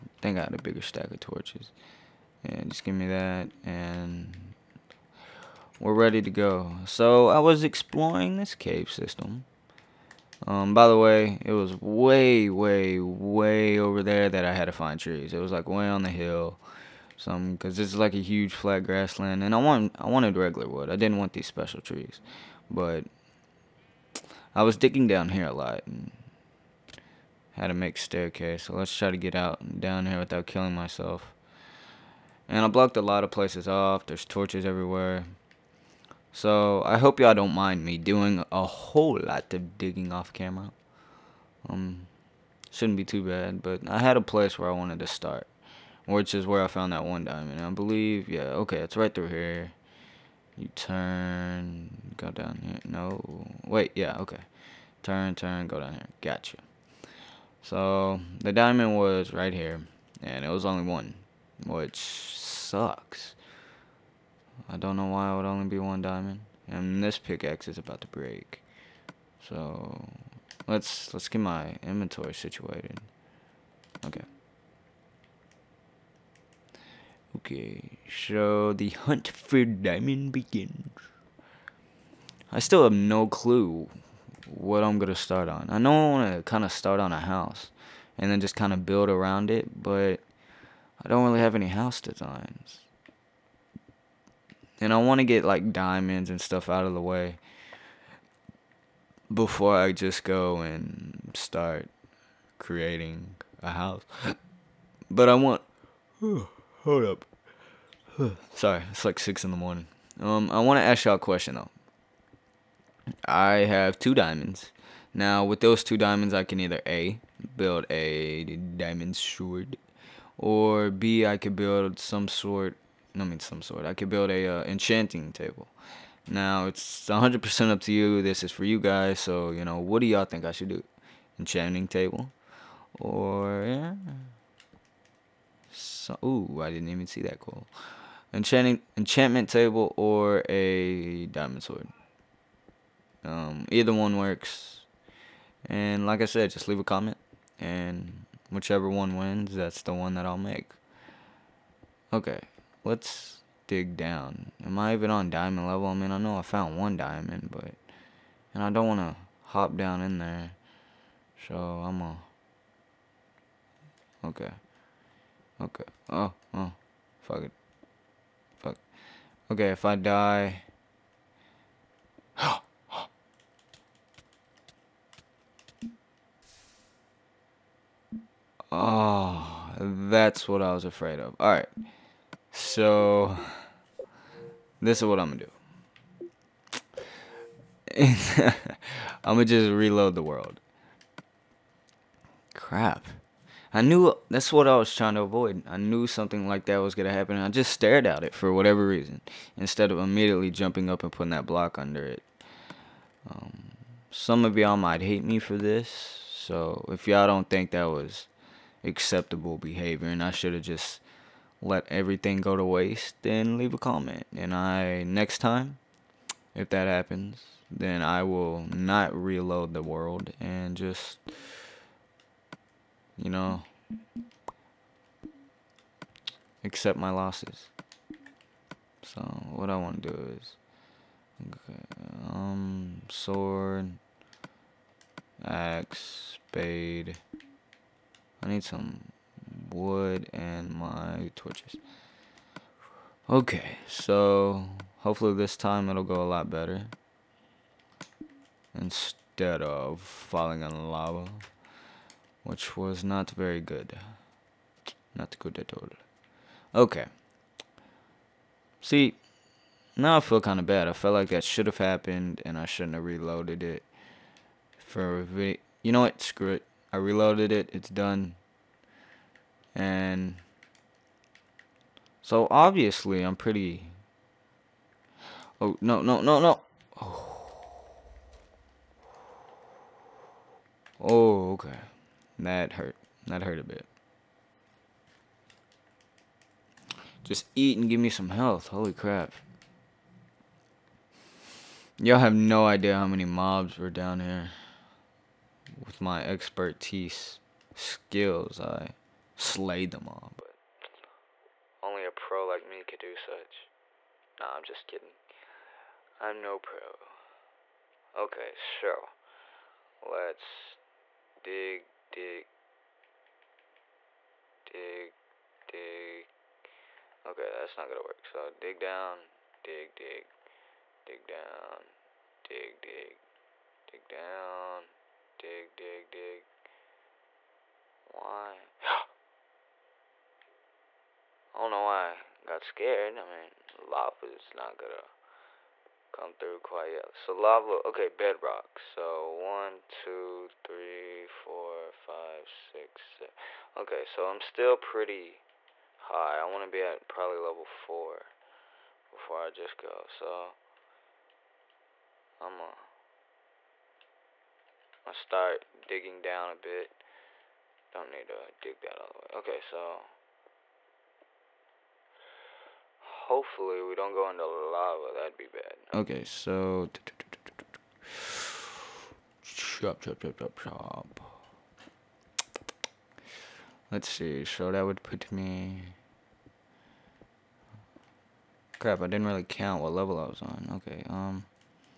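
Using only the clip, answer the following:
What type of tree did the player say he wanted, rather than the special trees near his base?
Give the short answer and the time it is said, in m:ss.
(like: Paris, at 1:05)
Regular wood, at 0:20.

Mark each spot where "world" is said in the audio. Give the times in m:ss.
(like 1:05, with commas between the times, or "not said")
3:10, 3:39.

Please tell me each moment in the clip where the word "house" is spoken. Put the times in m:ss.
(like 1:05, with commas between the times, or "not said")
1:27, 1:31, 1:43.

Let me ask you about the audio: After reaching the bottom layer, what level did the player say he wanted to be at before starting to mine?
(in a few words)
4.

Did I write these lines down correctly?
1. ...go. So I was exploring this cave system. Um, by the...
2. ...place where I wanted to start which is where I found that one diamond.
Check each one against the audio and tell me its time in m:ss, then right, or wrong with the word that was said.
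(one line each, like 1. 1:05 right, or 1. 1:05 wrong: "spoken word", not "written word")
1. 0:06 right
2. 0:44 right.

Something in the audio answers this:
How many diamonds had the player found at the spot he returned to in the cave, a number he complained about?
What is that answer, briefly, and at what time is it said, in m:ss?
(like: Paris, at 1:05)
1, at 1:00.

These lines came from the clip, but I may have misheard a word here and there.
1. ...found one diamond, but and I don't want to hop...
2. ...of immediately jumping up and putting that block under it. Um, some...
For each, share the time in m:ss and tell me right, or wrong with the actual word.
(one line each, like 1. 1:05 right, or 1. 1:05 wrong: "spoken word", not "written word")
1. 2:36 right
2. 3:19 right.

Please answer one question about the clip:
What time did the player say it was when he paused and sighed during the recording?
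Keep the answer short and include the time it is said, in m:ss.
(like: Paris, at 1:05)
six in the morning, at 1:49.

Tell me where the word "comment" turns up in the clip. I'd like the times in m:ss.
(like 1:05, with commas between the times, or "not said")
2:26, 3:33.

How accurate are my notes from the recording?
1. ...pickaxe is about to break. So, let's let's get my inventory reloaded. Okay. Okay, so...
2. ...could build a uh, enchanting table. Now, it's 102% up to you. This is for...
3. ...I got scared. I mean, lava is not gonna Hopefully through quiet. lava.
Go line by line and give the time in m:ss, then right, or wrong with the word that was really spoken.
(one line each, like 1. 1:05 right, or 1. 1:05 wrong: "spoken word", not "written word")
1. 1:07 wrong: "situated", not "reloaded"
2. 2:03 wrong: "100", not "102"
3. 5:31 wrong: "Come", not "Hopefully".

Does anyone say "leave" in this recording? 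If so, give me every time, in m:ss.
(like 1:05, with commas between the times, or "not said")
2:26, 3:33.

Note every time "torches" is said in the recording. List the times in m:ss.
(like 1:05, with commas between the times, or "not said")
0:01, 0:34, 4:01.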